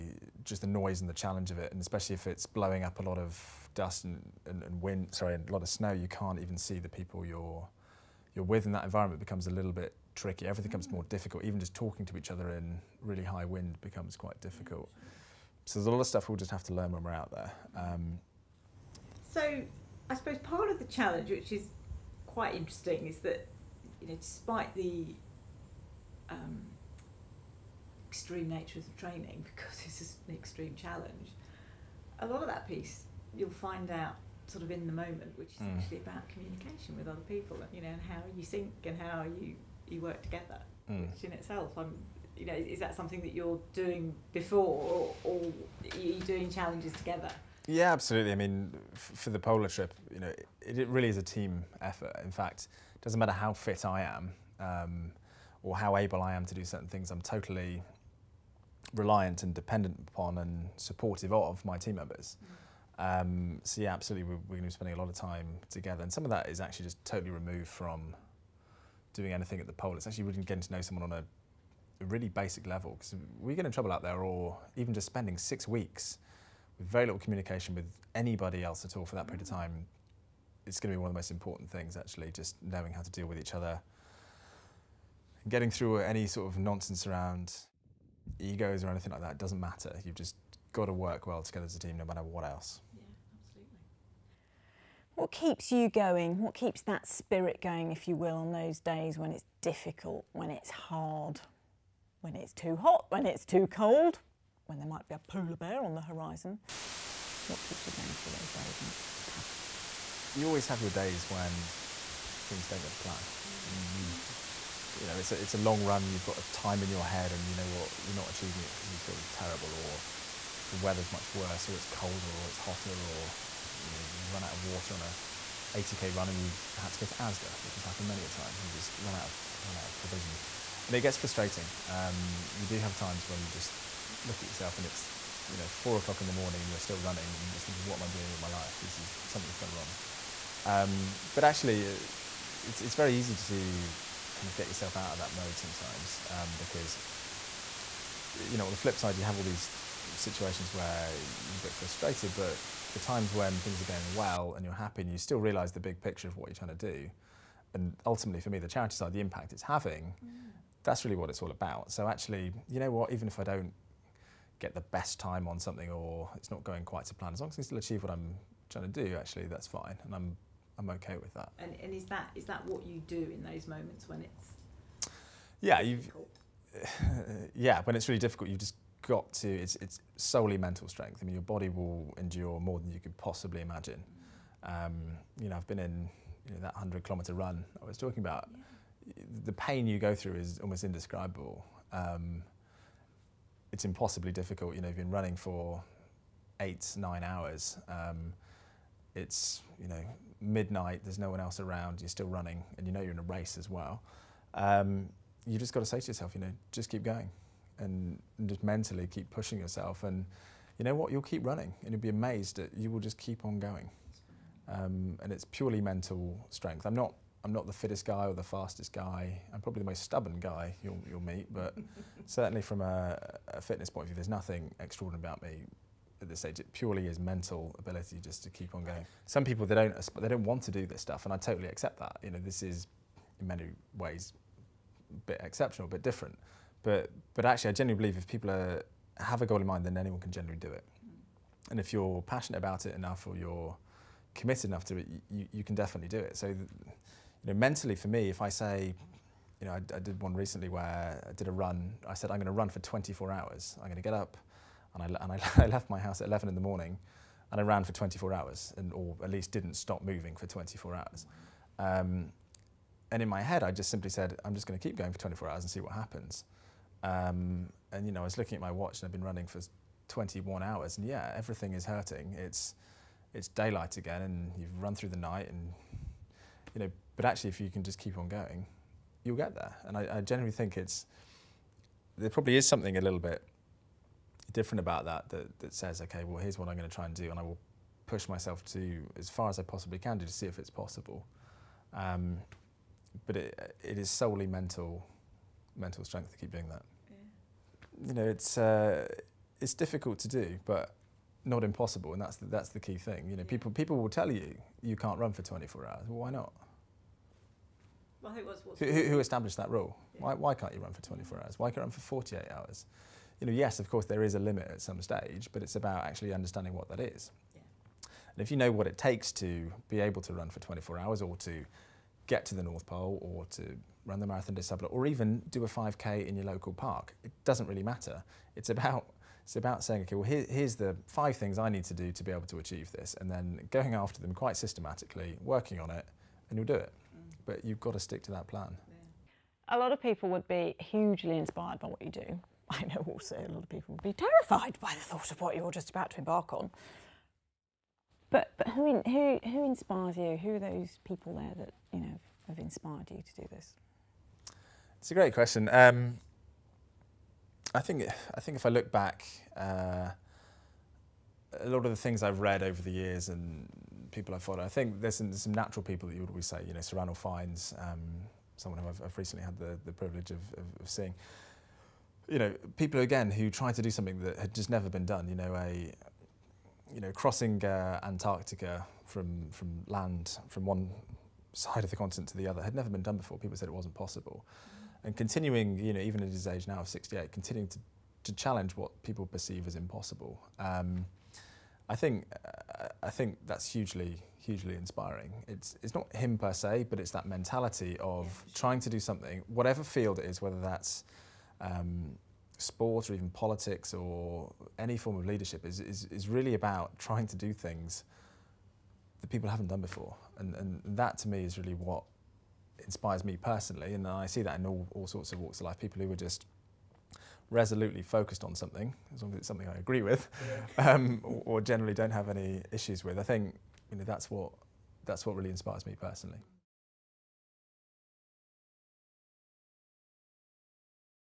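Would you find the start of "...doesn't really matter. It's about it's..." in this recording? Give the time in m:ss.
5:27.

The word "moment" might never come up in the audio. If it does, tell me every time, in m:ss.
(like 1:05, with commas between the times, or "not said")
0:34, 2:53.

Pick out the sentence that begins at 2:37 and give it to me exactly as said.
And ultimately, for me, the charity side, the impact it's having, mm.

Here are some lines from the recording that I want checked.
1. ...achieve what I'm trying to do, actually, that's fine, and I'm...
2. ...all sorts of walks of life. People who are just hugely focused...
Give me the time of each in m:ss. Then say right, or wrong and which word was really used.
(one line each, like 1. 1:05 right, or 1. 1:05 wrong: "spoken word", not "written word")
1. 2:47 right
2. 6:54 wrong: "resolutely", not "hugely".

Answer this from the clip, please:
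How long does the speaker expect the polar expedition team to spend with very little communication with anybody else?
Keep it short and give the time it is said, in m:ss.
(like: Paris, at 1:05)
6 weeks, at 1:15.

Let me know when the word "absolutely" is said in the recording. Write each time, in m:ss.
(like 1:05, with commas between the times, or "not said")
0:47, 1:03, 1:33.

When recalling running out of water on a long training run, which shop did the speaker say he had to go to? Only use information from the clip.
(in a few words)
ASDA.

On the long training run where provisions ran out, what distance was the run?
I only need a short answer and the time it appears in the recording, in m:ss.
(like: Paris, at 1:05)
80k, at 2:05.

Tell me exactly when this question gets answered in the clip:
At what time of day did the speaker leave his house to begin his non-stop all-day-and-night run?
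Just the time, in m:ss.
4:16.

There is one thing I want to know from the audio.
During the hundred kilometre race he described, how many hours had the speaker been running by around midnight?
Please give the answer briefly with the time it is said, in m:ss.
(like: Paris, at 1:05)
8 or 9 hours, at 3:16.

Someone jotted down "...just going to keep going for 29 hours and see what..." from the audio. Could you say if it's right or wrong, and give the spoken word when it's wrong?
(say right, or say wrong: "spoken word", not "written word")
wrong: "24", not "29".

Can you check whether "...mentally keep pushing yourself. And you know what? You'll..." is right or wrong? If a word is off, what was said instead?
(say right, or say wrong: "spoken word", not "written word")
right.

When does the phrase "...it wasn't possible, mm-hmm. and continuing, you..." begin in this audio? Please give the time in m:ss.
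6:23.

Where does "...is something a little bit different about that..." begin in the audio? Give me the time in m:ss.
4:42.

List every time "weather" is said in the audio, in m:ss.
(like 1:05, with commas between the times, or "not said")
2:00.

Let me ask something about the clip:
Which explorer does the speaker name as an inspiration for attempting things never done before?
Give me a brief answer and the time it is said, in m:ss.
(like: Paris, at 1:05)
Sir Ranulph Fiennes, at 6:06.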